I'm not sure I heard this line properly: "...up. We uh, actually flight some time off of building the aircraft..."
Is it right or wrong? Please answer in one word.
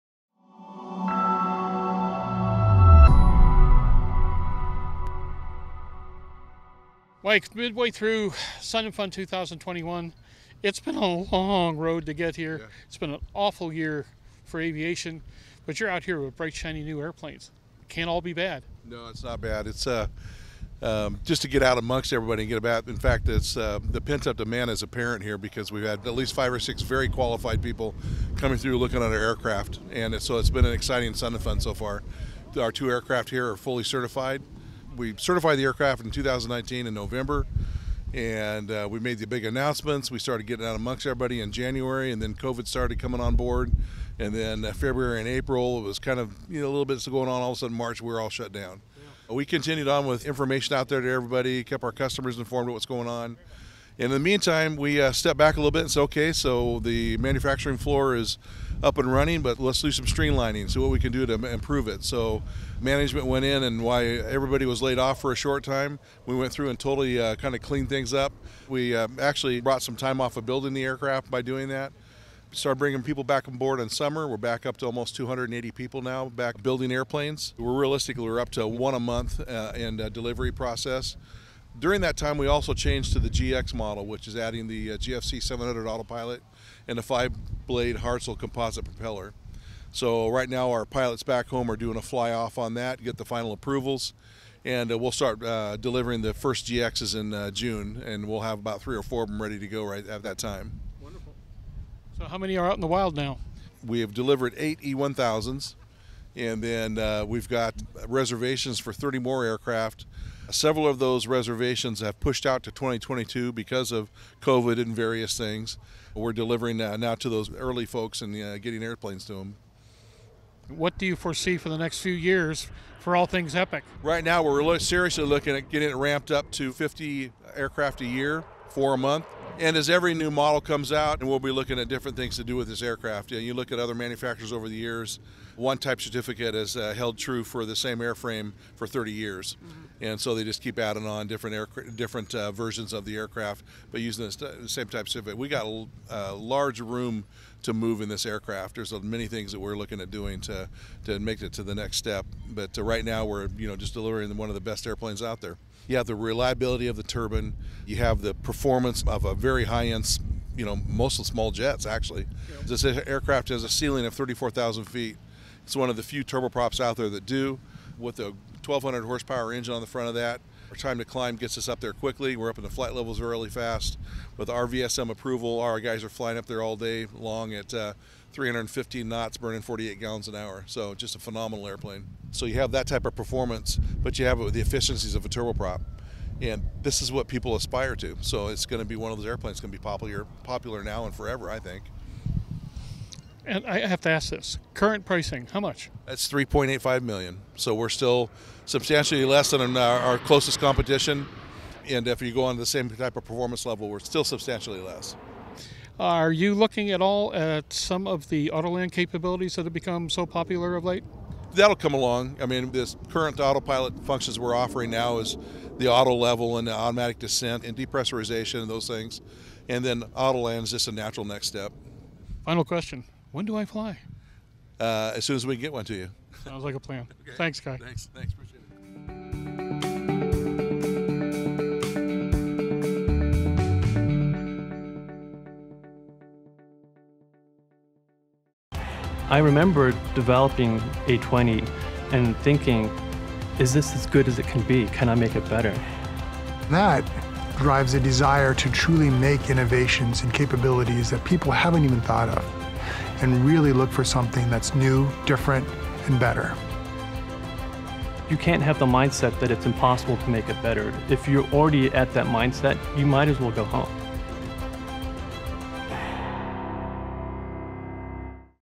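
wrong.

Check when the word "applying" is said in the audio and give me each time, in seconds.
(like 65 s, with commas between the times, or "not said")
not said.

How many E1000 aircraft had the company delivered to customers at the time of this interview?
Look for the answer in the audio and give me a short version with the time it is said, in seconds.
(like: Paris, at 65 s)
8, at 104 s.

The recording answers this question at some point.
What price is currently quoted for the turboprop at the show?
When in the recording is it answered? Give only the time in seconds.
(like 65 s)
196 s.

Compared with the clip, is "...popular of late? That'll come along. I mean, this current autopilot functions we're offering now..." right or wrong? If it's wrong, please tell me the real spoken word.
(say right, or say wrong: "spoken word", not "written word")
right.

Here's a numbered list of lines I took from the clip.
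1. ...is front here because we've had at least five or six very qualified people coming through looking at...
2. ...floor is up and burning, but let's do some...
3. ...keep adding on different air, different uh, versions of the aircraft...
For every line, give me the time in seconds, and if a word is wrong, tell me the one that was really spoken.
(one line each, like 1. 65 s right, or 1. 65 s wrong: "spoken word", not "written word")
1. 24 s wrong: "apparent", not "front"
2. 57 s wrong: "running", not "burning"
3. 140 s right.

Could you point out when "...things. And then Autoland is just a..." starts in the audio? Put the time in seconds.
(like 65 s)
218 s.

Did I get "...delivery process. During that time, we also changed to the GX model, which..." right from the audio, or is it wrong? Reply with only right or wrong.
right.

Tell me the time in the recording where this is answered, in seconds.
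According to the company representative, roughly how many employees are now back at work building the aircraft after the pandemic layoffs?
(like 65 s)
75 s.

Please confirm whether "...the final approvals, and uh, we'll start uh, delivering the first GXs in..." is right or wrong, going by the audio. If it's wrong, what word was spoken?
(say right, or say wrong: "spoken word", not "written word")
right.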